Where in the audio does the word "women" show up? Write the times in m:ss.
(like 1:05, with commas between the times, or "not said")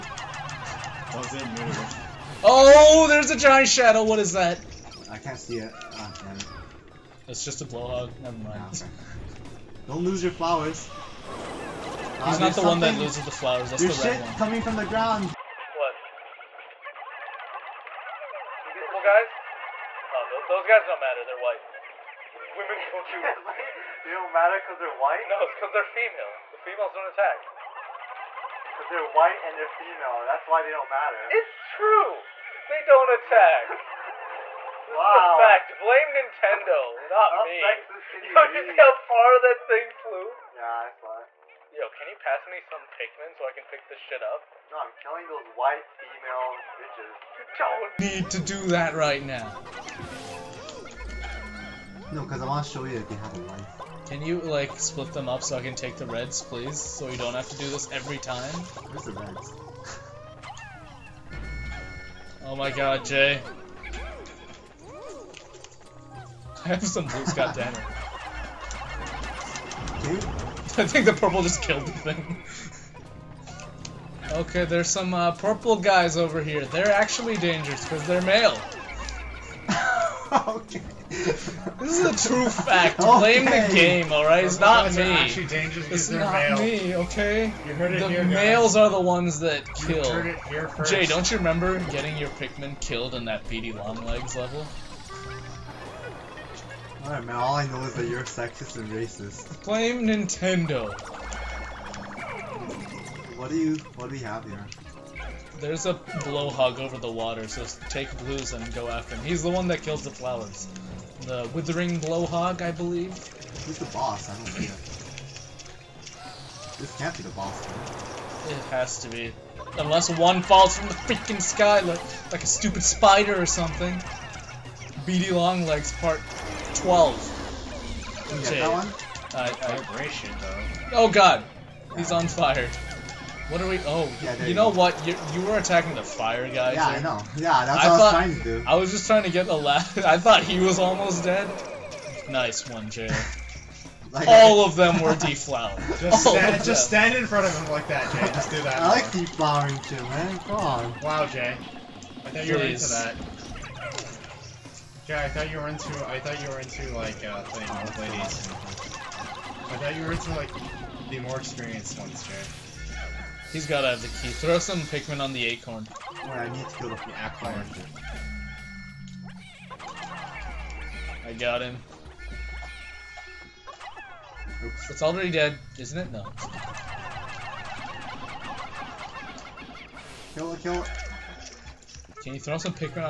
0:22.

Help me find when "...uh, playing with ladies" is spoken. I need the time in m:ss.
2:37.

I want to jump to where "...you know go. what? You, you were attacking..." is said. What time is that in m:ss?
2:14.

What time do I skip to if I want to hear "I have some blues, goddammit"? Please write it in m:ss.
1:06.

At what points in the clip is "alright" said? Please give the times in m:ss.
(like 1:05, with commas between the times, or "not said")
1:24, 1:37, 2:46.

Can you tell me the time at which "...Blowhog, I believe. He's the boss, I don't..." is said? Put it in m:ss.
1:51.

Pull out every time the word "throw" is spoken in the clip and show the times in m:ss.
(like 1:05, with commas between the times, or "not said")
2:44, 3:02.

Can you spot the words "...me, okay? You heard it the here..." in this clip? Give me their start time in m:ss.
1:26.